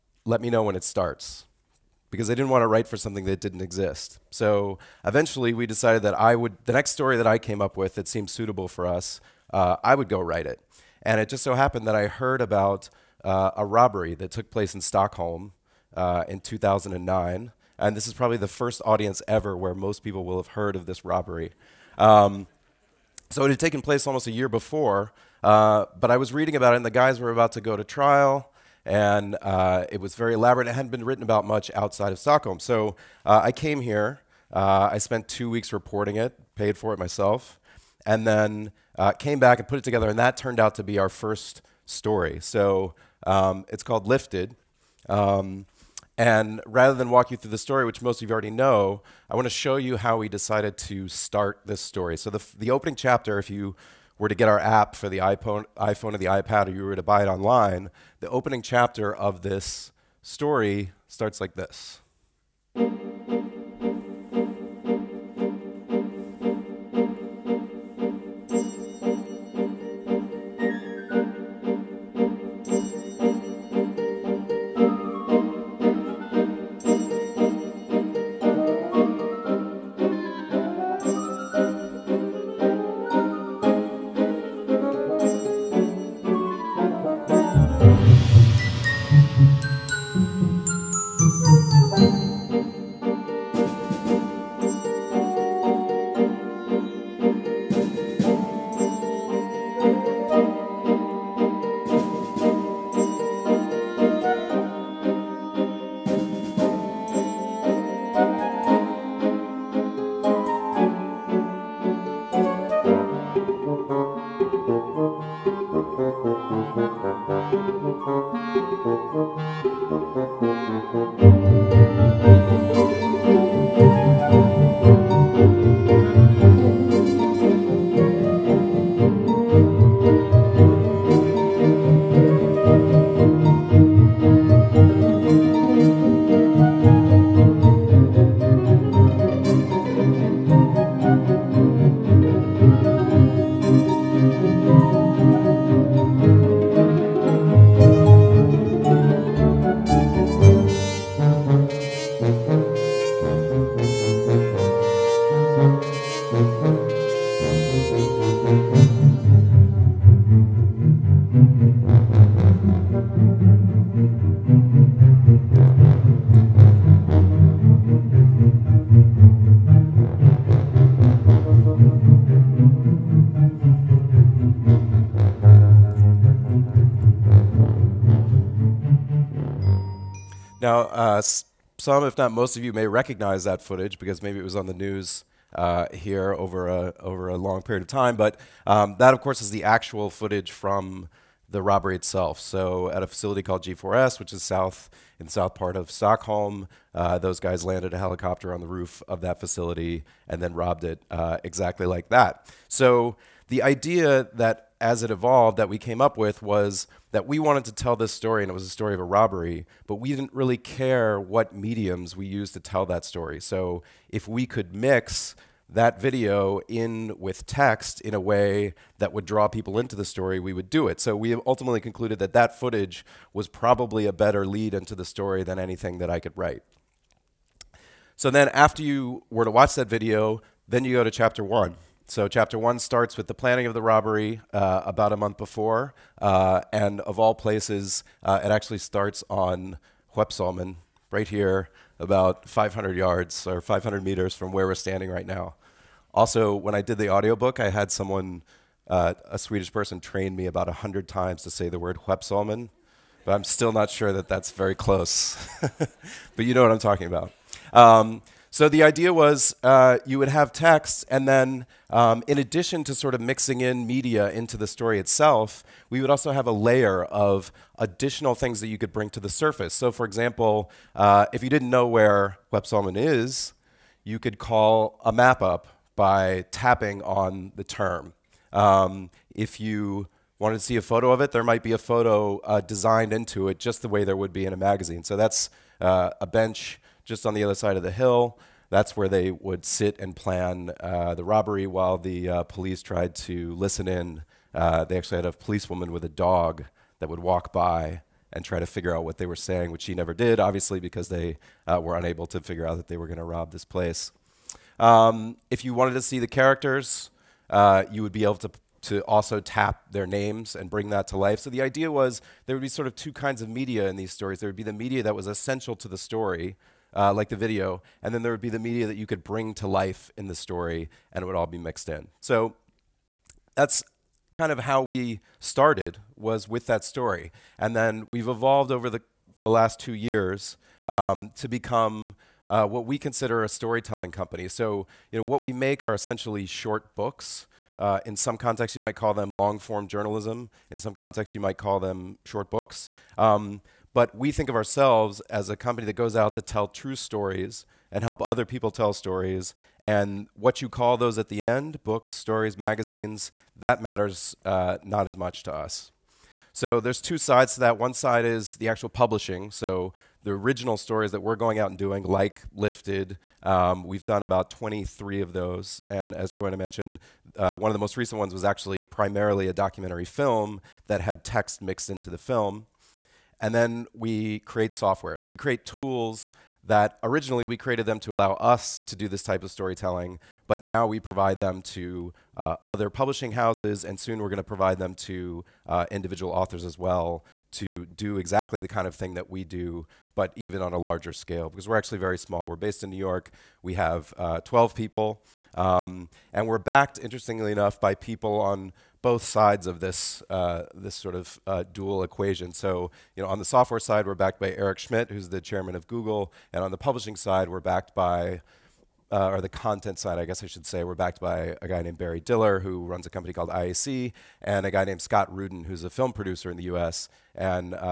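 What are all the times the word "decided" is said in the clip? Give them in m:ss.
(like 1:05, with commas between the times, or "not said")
0:05, 0:50.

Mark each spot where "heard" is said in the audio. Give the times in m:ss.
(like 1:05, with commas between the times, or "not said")
0:12, 0:20.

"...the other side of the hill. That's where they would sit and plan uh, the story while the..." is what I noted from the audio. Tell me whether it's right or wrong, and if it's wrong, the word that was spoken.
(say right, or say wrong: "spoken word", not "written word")
wrong: "robbery", not "story".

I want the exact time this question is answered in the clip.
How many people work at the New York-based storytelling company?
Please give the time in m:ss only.
6:34.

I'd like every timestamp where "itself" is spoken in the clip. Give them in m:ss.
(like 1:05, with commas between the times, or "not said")
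3:11, 4:24.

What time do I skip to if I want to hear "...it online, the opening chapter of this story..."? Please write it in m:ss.
0:57.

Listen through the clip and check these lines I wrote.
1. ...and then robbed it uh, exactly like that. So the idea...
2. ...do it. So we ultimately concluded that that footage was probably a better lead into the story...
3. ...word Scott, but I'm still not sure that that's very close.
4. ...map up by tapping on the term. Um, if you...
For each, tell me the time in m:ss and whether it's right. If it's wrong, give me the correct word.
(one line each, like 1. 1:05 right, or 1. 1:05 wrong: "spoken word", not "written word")
1. 3:20 right
2. 3:40 right
3. 4:11 wrong: "Huepsalmen", not "Scott"
4. 4:35 right.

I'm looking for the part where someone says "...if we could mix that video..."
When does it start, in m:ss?
3:34.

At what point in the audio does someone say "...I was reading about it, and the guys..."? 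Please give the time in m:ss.
0:26.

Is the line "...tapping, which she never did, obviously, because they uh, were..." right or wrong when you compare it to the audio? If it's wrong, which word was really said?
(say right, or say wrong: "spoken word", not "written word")
wrong: "saying", not "tapping".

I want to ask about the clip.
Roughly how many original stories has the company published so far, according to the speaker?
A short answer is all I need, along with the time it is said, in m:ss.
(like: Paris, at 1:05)
23, at 6:04.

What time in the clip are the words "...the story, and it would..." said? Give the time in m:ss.
5:20.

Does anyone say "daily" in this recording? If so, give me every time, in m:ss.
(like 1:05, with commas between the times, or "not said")
not said.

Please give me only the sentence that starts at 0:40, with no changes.
And that turned out to be our first story.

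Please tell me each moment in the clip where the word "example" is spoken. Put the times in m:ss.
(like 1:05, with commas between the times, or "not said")
4:30.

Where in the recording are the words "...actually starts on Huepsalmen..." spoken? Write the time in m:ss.
3:58.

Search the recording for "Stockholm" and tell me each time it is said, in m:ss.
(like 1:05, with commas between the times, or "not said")
0:14, 0:32, 3:15.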